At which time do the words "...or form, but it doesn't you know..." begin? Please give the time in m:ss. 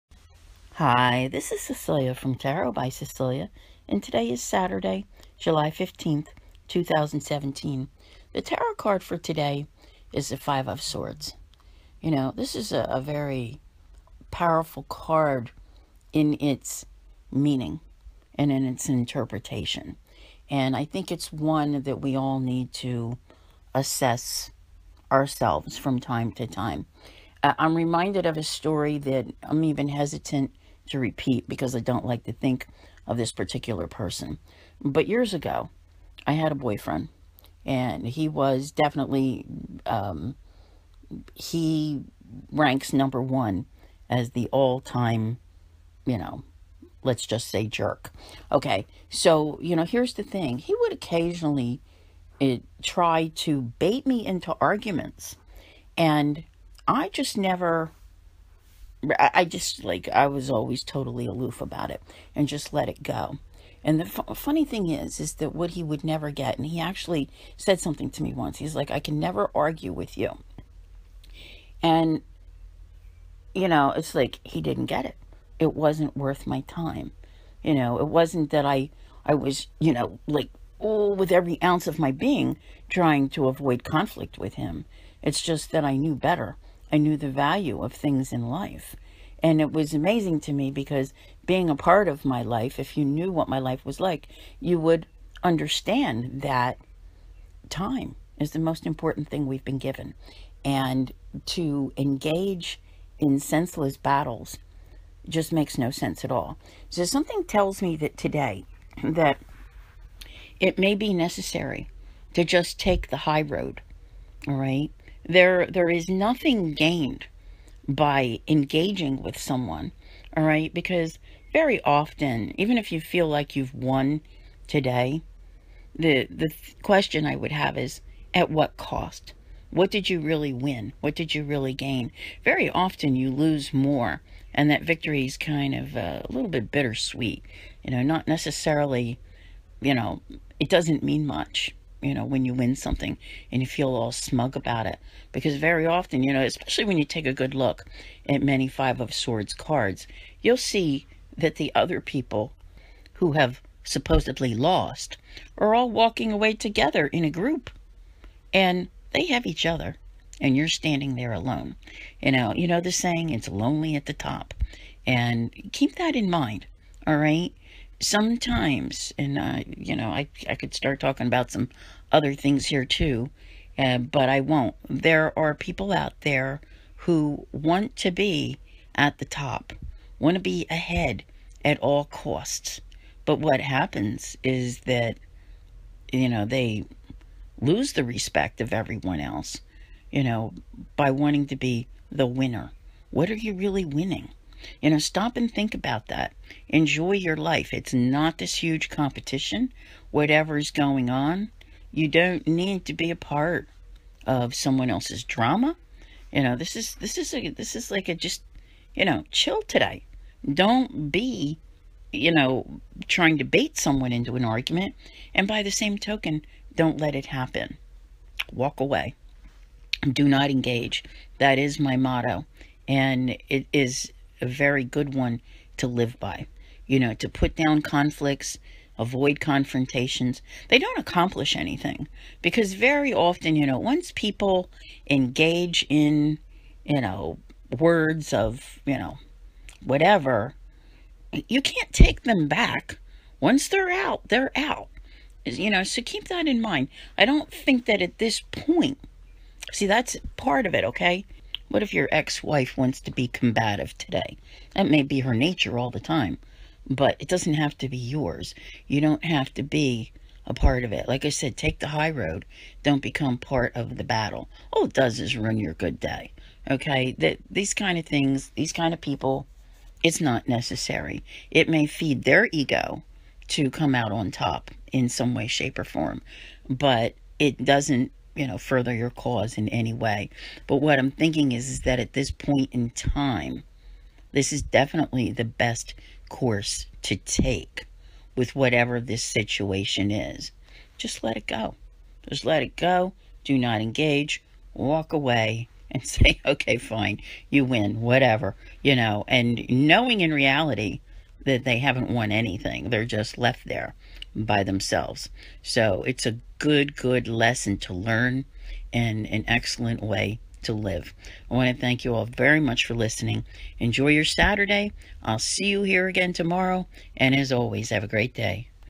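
4:35.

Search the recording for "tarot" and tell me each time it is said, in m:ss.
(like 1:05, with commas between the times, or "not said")
0:02, 0:08.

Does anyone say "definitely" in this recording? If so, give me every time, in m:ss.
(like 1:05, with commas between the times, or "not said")
0:38, 4:44.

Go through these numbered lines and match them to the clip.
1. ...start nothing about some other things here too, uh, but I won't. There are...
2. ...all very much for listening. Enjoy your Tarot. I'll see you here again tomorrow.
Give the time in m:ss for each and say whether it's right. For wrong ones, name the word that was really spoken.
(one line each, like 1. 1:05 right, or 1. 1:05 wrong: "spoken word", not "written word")
1. 2:50 wrong: "talking", not "nothing"
2. 5:12 wrong: "Saturday", not "Tarot".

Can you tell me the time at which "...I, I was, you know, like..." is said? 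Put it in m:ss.
1:18.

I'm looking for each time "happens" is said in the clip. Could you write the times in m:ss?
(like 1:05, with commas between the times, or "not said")
3:03, 3:37.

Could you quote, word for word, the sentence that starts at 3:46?
You know, to put down conflicts, avoid confrontations.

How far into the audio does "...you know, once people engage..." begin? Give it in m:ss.
3:53.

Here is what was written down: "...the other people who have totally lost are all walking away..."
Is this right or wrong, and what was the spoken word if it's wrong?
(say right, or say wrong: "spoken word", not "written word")
wrong: "supposedly", not "totally".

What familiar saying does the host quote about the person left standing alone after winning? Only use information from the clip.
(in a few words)
It's lonely at the top.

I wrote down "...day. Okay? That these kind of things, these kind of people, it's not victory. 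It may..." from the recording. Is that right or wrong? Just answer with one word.
wrong.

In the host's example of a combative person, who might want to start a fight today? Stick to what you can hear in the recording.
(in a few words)
Ex-wife.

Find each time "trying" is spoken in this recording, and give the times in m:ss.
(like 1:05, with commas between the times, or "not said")
1:22, 3:33.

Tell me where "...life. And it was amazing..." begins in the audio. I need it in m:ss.
1:28.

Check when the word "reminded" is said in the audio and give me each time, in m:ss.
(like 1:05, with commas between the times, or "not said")
0:27.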